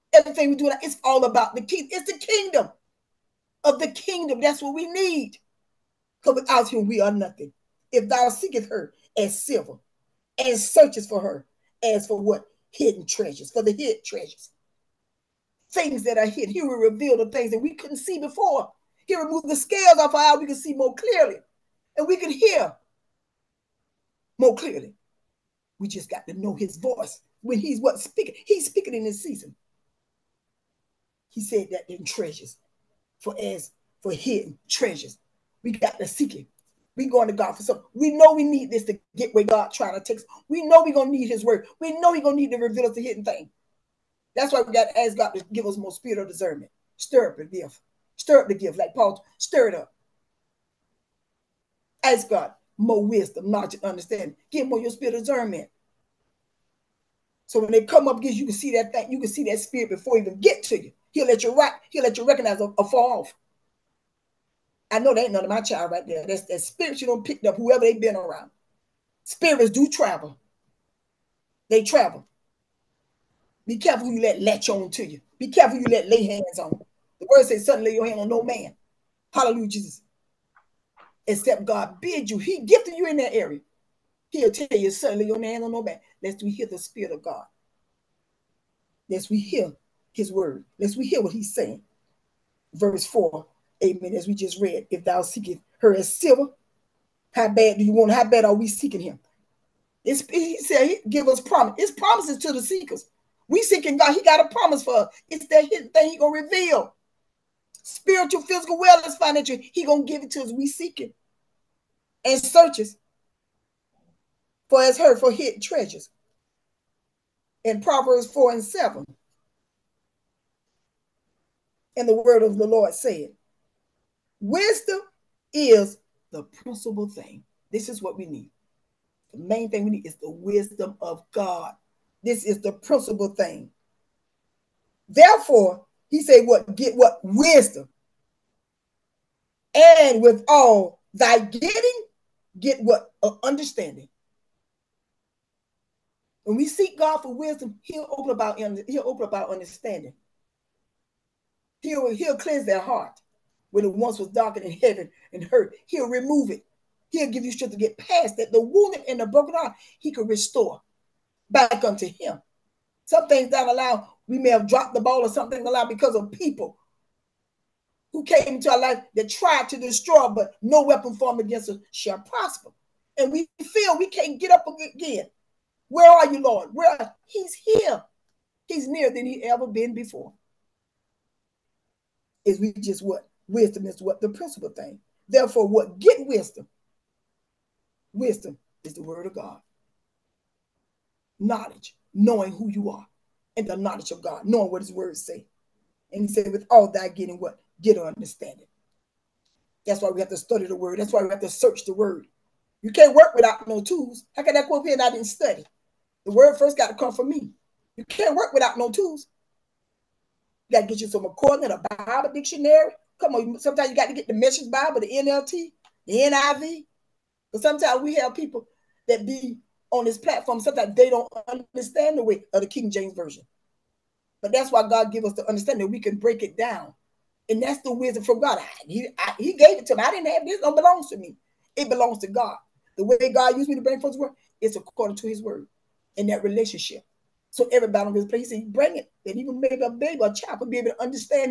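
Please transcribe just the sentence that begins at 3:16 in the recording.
And he said, with all that getting what?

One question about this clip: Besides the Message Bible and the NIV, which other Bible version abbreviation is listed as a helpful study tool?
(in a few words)
NLT.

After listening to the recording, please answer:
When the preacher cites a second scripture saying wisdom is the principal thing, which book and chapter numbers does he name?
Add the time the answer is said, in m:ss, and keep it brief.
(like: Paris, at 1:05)
Proverbs 4 and 7, at 1:57.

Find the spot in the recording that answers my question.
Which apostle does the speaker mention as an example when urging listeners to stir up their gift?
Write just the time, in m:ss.
0:48.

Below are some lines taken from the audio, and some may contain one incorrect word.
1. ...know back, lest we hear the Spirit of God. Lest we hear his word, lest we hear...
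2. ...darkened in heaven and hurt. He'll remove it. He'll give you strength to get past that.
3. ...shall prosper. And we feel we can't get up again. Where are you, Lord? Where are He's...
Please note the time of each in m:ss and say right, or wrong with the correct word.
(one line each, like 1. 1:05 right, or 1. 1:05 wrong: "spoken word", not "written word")
1. 1:25 right
2. 2:34 right
3. 2:51 right.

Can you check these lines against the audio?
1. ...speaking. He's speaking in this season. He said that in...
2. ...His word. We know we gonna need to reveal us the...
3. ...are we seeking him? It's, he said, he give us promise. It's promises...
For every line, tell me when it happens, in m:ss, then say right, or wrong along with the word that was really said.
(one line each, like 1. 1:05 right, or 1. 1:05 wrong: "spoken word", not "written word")
1. 0:27 right
2. 0:41 right
3. 1:38 right.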